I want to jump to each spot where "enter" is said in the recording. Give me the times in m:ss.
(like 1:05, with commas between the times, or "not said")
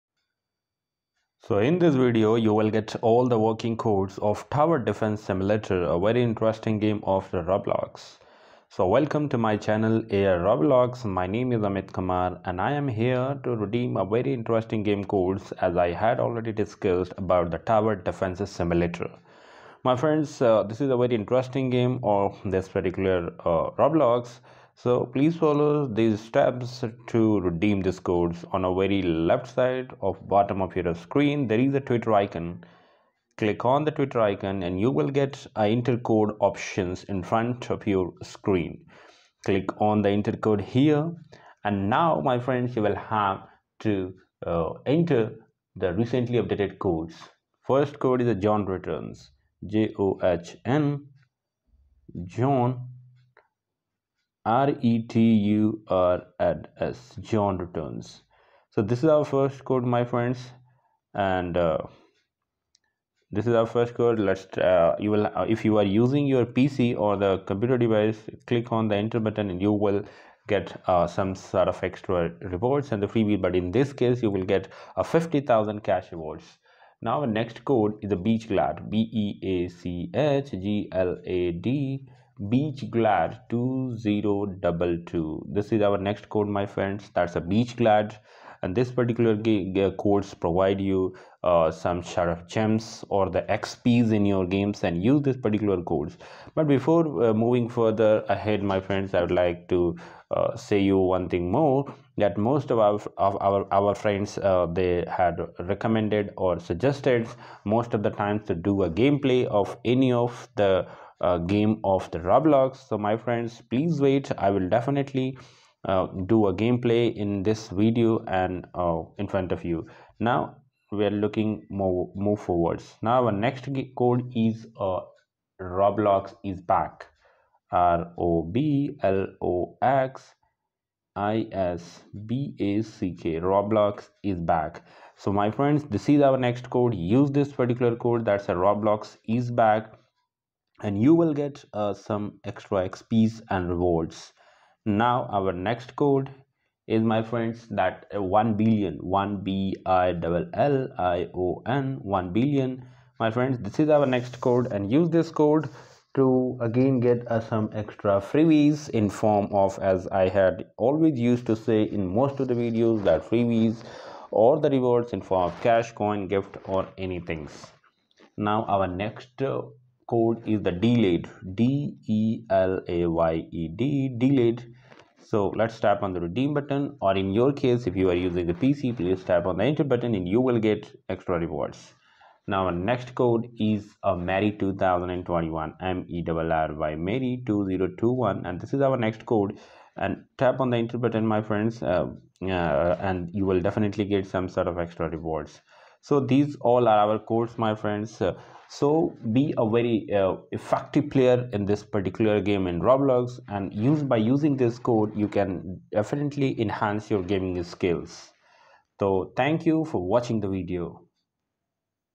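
0:44, 1:08, 2:59, 3:10.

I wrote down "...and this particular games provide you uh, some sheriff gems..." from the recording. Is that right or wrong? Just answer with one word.
wrong.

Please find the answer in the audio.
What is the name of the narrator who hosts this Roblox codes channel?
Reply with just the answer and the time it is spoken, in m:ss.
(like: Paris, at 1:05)
Amit Kumar, at 0:11.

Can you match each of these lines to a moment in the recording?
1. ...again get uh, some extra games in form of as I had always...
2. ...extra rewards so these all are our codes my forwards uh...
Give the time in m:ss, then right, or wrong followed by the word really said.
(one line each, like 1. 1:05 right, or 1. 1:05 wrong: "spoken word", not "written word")
1. 2:36 wrong: "freebies", not "games"
2. 3:14 wrong: "friends", not "forwards".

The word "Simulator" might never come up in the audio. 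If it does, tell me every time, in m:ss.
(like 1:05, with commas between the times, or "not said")
0:05, 0:18.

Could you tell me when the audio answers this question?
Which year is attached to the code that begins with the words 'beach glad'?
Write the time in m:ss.
1:23.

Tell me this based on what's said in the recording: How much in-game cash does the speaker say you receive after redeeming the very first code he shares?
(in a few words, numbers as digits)
50000.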